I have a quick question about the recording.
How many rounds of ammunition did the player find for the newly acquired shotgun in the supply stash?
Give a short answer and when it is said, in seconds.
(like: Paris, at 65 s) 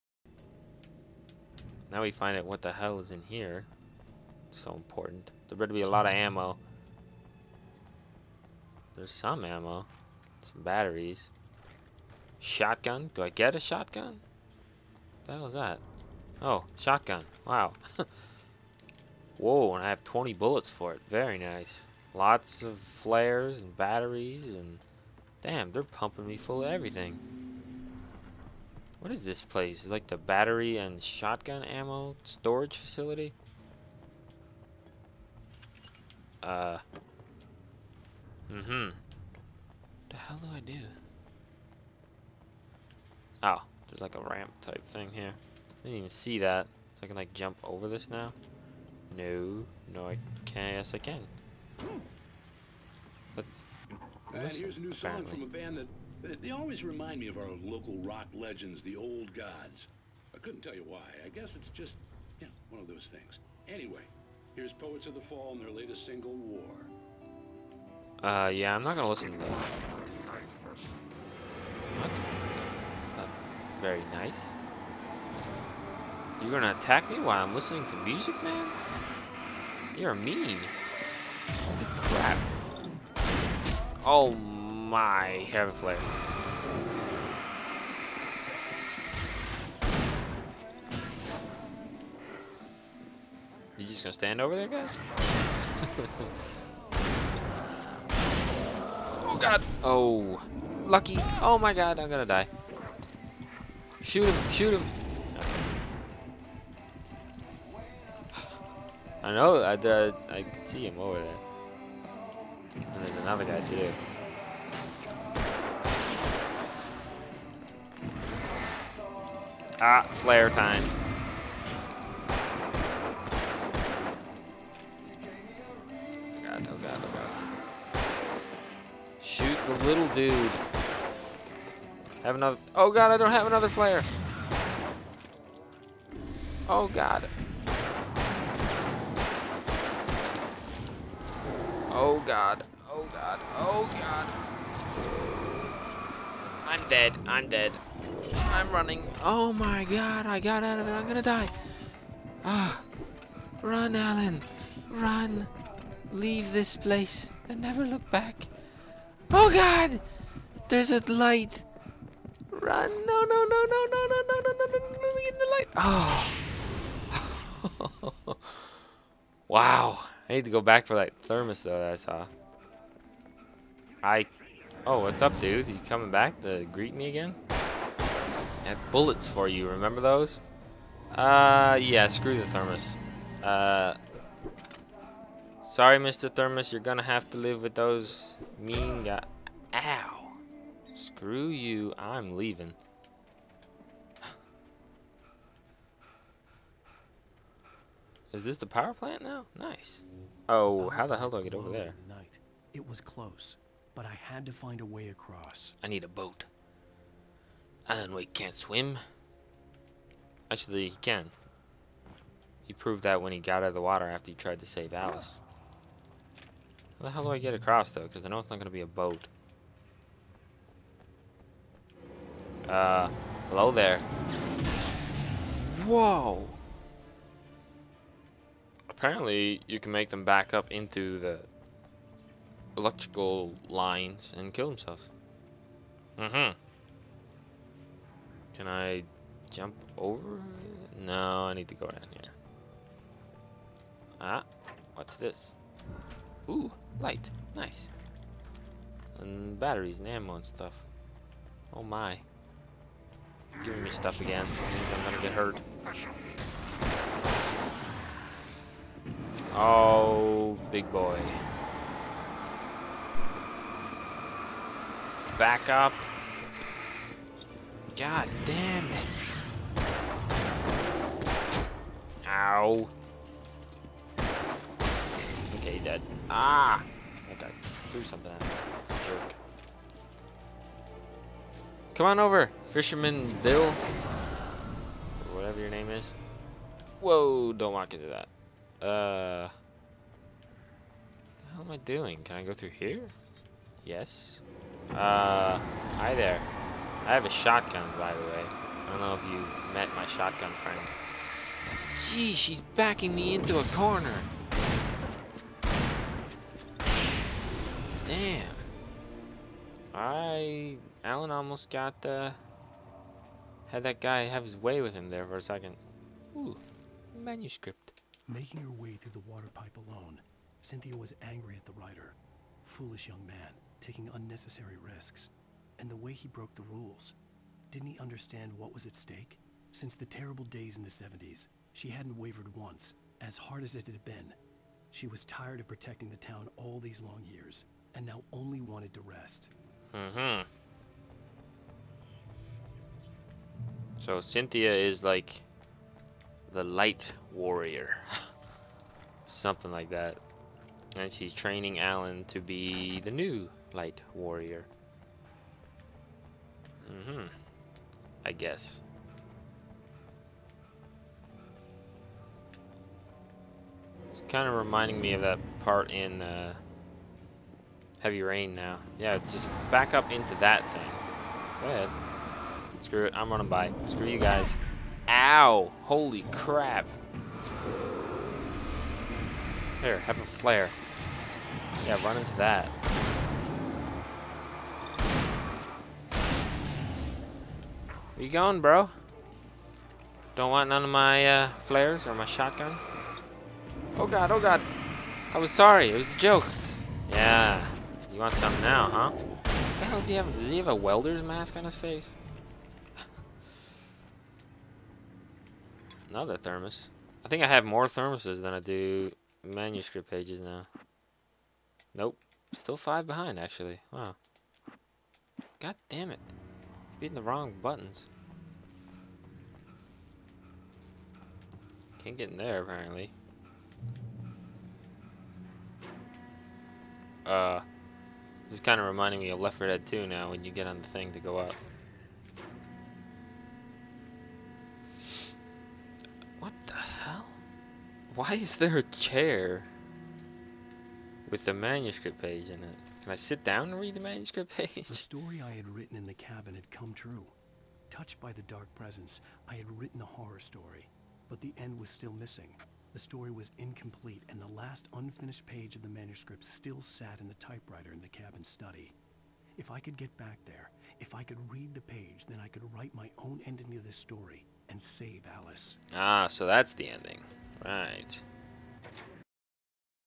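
20, at 20 s.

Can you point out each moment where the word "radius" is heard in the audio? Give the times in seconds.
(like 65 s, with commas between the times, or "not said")
not said.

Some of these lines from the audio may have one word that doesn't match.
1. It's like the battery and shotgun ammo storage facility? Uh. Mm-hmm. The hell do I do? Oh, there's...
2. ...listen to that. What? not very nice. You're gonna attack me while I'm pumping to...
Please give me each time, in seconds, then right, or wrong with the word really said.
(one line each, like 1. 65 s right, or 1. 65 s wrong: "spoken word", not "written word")
1. 29 s right
2. 69 s wrong: "listening", not "pumping".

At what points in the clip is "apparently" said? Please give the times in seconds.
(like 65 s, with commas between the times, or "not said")
55 s, 228 s, 422 s.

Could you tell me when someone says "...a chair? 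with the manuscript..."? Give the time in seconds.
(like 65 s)
438 s.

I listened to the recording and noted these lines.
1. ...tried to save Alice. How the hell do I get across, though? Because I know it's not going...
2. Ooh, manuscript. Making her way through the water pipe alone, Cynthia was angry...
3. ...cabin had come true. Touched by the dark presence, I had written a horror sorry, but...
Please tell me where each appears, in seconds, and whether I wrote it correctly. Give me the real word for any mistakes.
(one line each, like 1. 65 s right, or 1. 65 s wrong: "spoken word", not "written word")
1. 214 s right
2. 316 s right
3. 446 s wrong: "story", not "sorry".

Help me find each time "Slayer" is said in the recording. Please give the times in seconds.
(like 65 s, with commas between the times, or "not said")
120 s, 133 s.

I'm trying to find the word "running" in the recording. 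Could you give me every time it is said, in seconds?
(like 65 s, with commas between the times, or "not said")
148 s, 373 s.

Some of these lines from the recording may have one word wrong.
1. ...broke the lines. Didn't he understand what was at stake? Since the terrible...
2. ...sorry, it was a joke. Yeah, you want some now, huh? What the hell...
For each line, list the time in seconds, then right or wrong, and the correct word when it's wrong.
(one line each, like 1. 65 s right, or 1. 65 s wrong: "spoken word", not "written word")
1. 326 s wrong: "rules", not "lines"
2. 395 s right.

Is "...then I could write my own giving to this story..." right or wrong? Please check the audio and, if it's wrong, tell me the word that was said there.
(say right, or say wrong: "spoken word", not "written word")
wrong: "ending", not "giving".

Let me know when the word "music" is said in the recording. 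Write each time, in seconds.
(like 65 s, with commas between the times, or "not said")
77 s.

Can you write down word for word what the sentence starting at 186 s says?
Thermos, you're gonna have to live with those mean guys.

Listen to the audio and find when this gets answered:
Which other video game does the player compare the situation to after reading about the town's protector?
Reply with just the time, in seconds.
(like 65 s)
368 s.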